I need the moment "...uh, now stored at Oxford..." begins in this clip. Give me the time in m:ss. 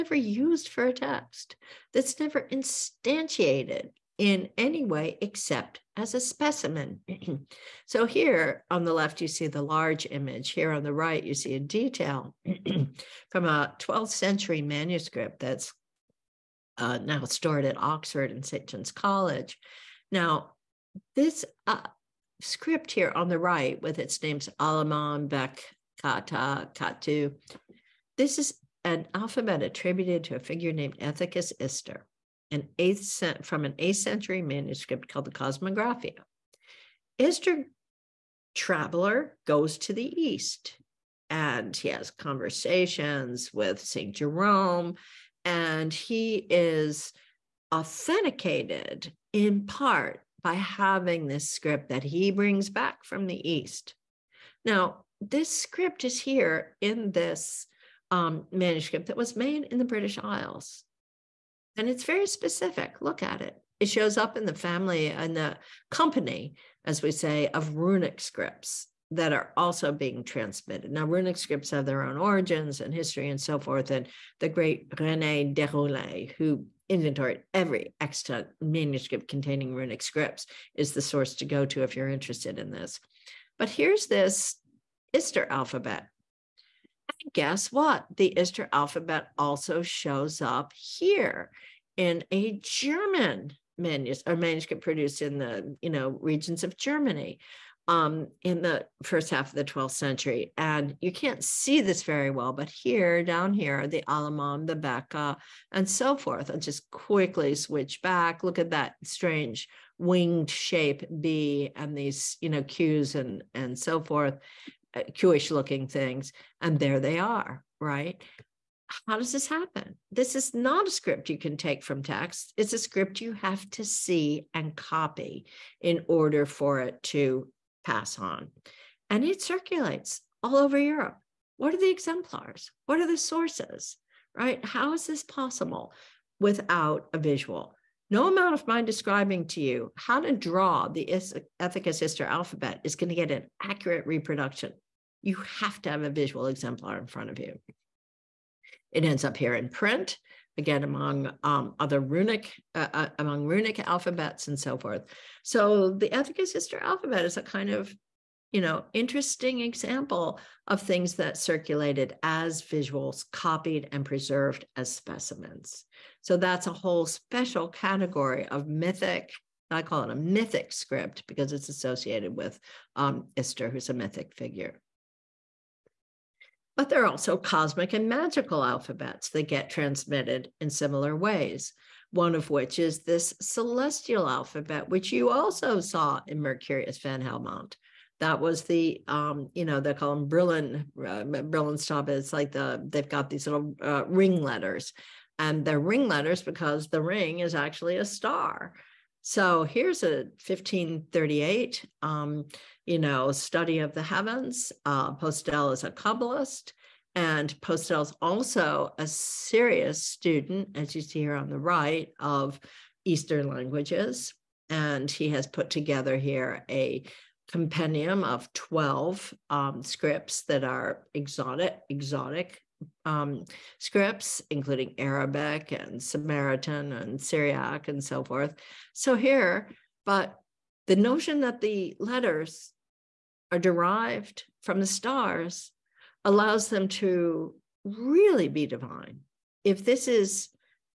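0:16.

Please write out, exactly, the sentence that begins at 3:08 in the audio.
That was the, um, you know, they call them Brillen, uh, Brillenstab.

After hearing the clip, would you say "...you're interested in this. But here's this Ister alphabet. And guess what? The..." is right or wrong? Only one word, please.
right.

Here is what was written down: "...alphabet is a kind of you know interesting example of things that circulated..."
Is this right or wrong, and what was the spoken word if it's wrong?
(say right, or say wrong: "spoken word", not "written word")
right.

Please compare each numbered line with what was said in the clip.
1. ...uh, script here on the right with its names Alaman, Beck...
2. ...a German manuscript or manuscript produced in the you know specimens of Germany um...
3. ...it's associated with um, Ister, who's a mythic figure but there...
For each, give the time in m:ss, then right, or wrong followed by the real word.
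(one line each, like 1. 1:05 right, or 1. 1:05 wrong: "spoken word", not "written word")
1. 0:21 right
2. 1:32 wrong: "regions", not "specimens"
3. 2:51 right.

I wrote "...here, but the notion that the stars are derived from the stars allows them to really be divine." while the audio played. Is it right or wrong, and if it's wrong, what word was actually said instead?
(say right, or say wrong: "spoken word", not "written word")
wrong: "letters", not "stars".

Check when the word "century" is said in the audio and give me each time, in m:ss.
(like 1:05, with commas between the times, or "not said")
0:14, 0:33, 1:39.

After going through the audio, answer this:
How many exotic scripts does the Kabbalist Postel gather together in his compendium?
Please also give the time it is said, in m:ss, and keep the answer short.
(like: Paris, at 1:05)
12, at 3:38.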